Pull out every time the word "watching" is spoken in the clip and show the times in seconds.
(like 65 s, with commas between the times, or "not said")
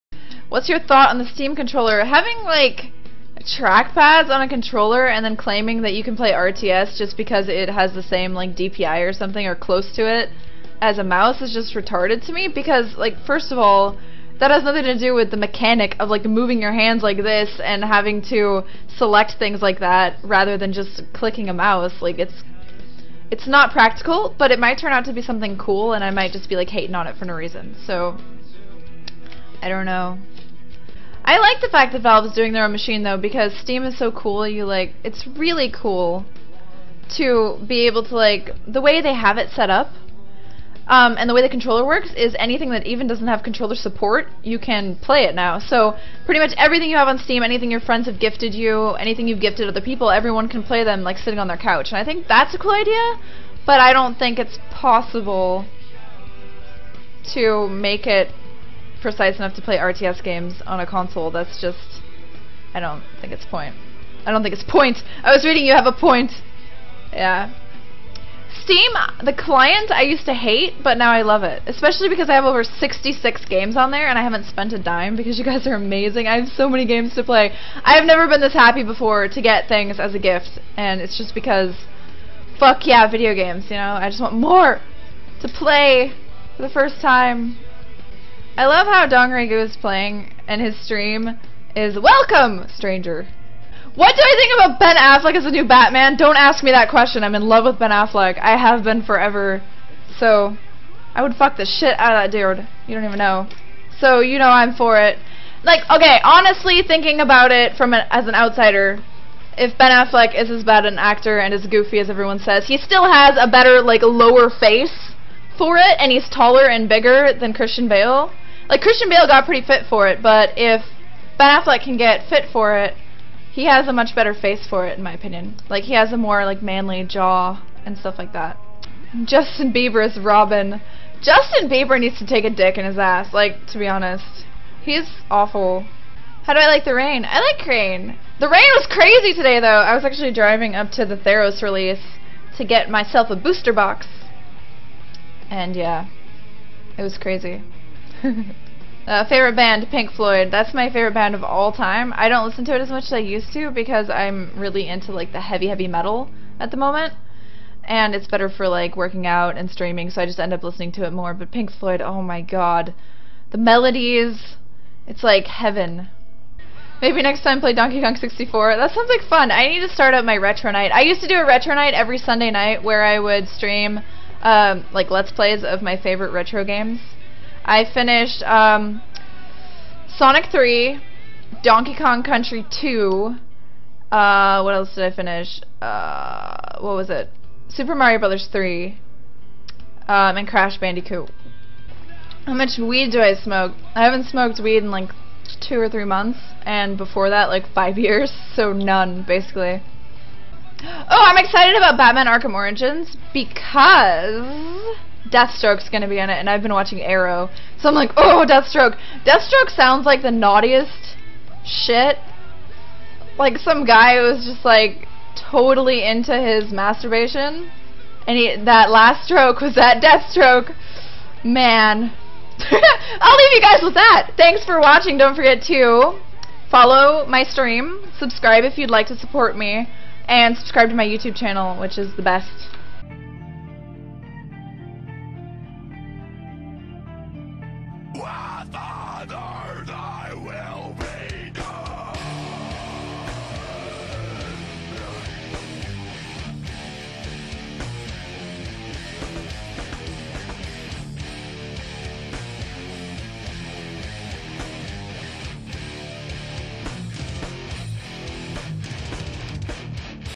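206 s, 224 s.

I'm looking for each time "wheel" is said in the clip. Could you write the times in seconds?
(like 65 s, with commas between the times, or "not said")
not said.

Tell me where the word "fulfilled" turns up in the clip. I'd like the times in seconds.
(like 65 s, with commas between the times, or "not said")
not said.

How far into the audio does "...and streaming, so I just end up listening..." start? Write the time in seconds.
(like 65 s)
159 s.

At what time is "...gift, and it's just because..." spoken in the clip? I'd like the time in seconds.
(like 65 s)
80 s.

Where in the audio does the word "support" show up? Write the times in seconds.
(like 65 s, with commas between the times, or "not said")
43 s, 229 s.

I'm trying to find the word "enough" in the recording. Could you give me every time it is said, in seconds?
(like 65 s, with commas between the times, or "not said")
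59 s.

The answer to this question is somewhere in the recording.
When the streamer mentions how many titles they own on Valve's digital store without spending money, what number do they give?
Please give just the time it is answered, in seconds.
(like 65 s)
72 s.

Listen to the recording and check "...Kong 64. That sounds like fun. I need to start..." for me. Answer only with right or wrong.
right.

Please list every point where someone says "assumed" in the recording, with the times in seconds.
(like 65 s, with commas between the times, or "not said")
not said.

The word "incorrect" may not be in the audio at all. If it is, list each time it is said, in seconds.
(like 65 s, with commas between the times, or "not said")
not said.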